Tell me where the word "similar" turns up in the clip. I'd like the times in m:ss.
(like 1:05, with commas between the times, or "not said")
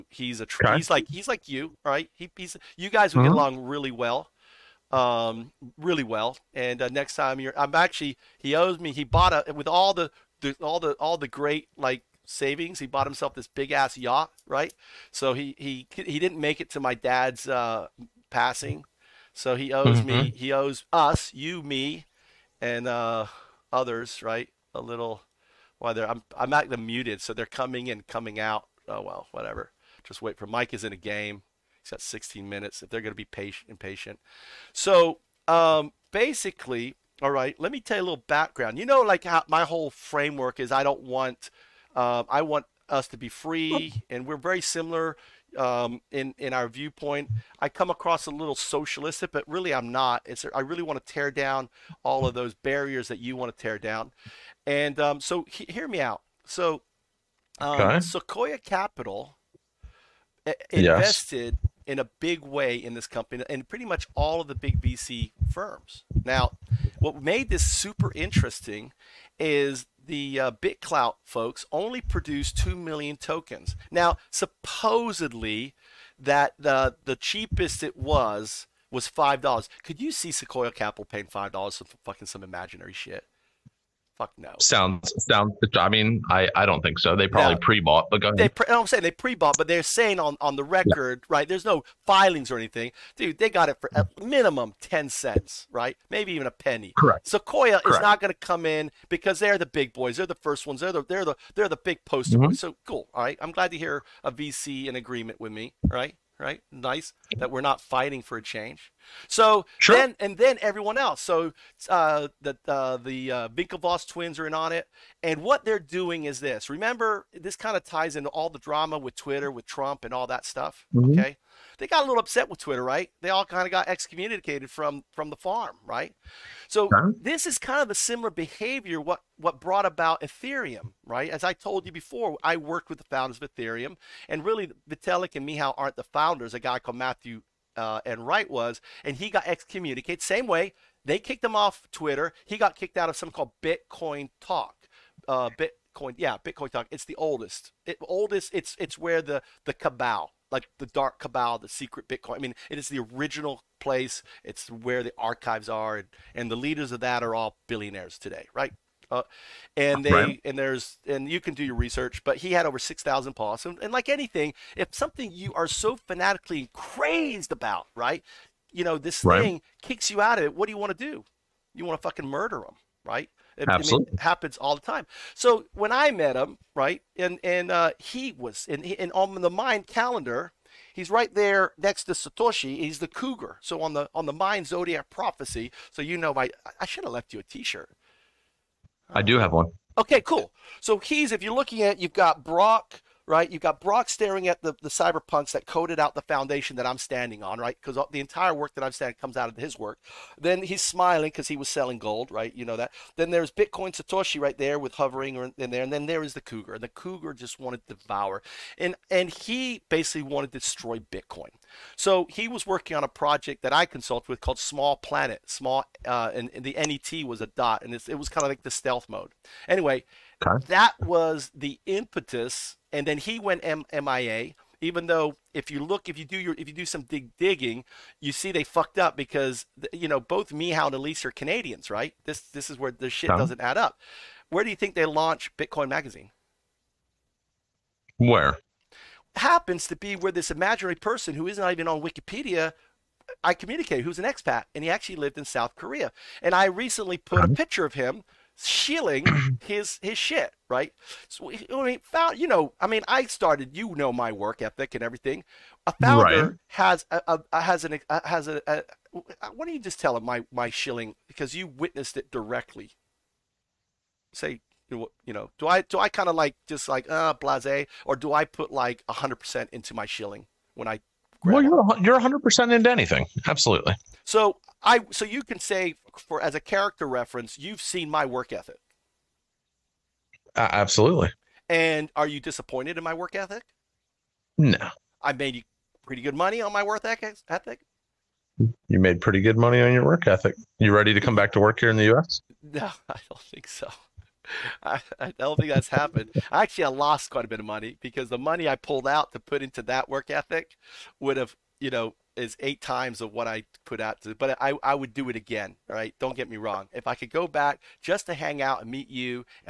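0:44, 2:07.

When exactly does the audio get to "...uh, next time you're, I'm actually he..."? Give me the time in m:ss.
0:06.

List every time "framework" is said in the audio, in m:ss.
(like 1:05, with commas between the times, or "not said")
0:39.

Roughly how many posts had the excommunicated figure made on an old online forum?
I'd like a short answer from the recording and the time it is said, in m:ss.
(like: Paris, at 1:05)
6,000, at 2:42.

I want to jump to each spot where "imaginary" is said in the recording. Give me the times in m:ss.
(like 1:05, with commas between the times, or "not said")
1:22, 4:00.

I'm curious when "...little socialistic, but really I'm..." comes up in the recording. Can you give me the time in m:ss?
0:48.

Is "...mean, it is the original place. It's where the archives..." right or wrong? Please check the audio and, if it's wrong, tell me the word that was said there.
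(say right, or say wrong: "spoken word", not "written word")
right.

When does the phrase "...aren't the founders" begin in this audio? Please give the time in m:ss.
2:15.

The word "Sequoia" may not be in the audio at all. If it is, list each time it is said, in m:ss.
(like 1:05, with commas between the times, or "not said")
0:57, 1:20, 1:37.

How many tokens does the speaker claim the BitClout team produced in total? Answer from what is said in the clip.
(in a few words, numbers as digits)
2 million.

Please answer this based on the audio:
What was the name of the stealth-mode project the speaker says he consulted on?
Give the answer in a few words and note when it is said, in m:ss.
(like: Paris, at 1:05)
Small Planet, at 3:34.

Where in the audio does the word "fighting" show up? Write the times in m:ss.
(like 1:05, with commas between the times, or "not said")
1:47.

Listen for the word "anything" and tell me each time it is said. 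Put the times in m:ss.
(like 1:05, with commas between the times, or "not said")
1:32, 2:44, 4:32.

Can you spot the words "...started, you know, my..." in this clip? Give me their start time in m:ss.
4:13.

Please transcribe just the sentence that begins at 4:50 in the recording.
You ready to come back to work here in the U.S.?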